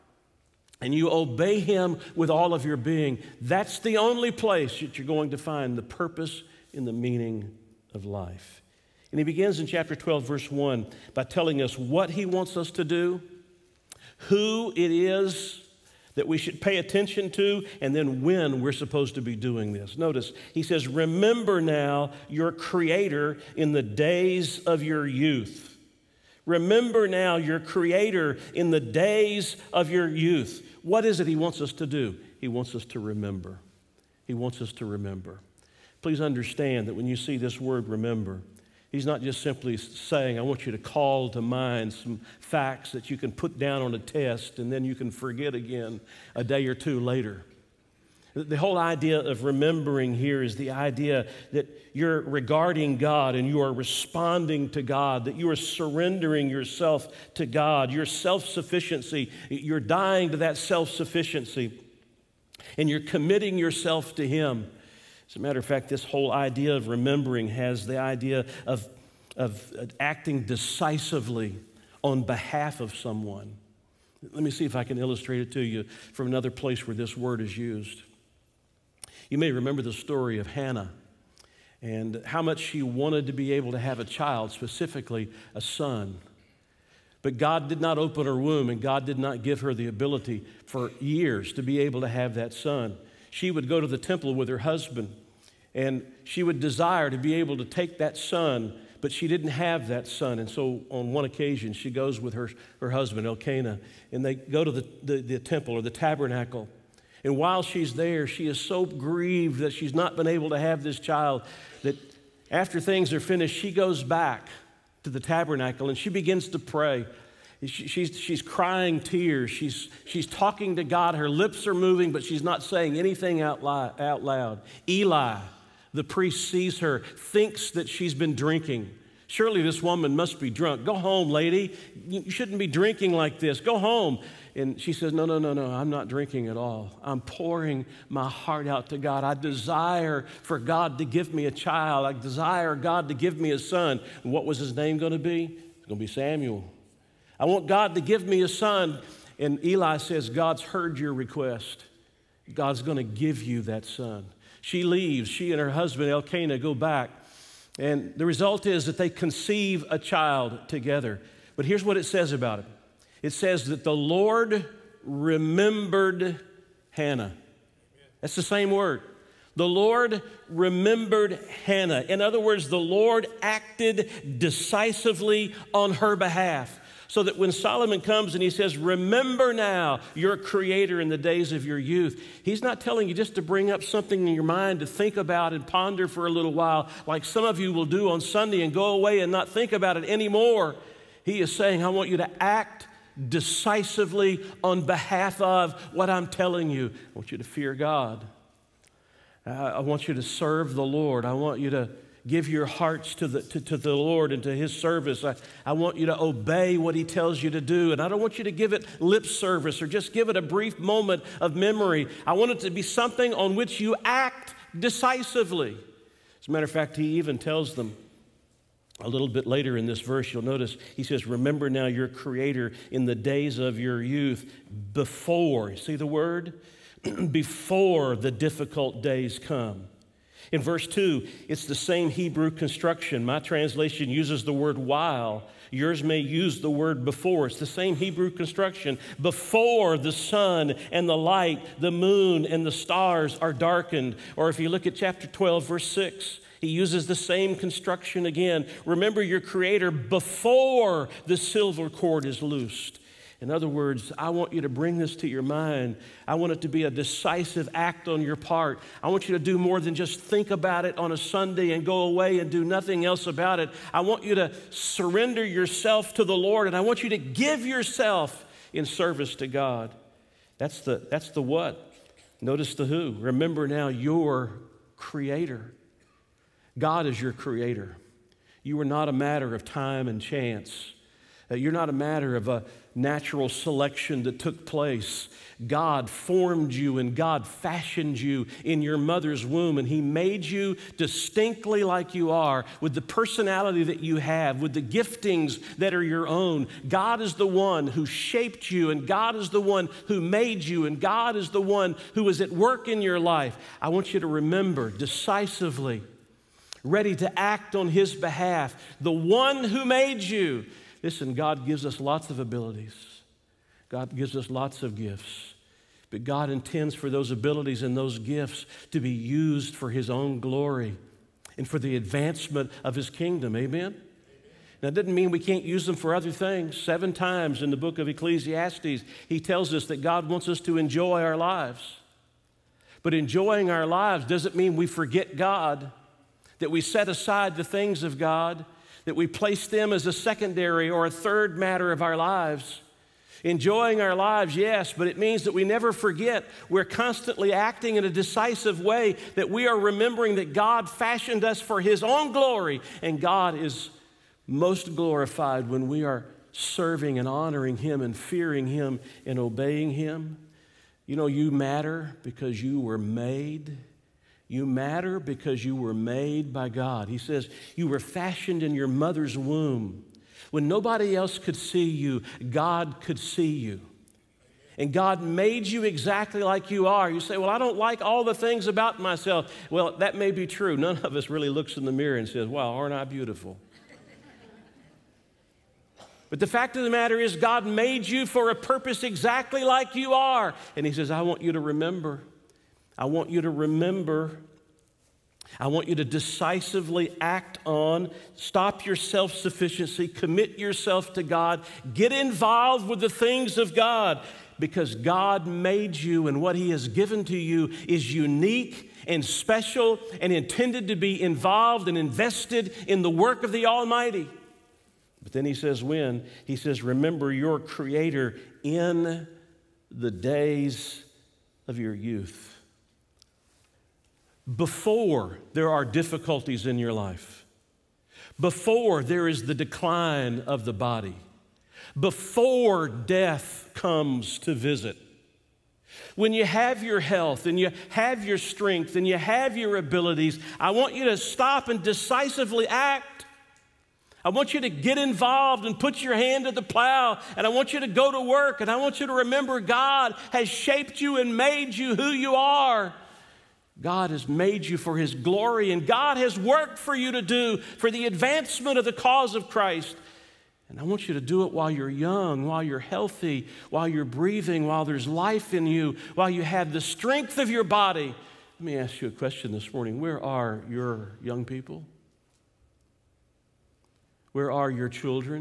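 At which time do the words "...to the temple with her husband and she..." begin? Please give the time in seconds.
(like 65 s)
93 s.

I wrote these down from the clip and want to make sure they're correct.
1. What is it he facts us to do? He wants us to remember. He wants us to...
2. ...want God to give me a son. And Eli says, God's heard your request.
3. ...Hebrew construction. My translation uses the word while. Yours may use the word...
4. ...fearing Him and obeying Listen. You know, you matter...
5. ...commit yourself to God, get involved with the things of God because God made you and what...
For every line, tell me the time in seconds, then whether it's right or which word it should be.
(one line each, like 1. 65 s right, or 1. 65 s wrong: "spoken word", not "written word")
1. 30 s wrong: "wants", not "facts"
2. 147 s right
3. 232 s right
4. 358 s wrong: "Him", not "Listen"
5. 400 s right.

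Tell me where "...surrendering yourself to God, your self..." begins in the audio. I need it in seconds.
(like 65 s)
55 s.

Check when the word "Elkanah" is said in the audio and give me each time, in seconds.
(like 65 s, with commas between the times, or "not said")
103 s, 156 s.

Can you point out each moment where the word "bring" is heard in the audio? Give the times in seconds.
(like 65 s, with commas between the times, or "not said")
183 s, 254 s.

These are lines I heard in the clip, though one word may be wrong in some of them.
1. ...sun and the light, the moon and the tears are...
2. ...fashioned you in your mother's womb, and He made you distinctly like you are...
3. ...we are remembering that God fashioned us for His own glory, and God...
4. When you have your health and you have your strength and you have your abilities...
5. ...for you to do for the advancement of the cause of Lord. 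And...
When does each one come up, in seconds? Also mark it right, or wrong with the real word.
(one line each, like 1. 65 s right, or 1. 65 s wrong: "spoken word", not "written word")
1. 240 s wrong: "stars", not "tears"
2. 287 s right
3. 349 s right
4. 436 s right
5. 456 s wrong: "Christ", not "Lord".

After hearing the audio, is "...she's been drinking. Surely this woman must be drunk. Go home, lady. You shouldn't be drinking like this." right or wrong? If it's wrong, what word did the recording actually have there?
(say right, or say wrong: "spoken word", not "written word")
right.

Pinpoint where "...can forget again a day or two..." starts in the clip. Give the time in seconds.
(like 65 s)
44 s.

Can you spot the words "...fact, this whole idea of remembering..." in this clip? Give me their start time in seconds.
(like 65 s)
65 s.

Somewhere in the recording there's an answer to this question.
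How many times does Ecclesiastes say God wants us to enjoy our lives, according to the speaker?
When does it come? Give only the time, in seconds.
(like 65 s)
326 s.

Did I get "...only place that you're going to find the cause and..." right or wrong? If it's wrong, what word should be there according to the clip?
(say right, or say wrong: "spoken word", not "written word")
wrong: "purpose", not "cause".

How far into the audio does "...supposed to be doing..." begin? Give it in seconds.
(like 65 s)
18 s.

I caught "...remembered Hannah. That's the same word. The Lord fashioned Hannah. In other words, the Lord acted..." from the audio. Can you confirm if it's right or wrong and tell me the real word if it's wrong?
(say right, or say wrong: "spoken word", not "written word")
wrong: "remembered", not "fashioned".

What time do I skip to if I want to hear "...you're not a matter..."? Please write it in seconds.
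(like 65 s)
281 s.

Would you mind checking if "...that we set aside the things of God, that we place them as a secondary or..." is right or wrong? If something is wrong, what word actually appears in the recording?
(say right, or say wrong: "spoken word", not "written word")
right.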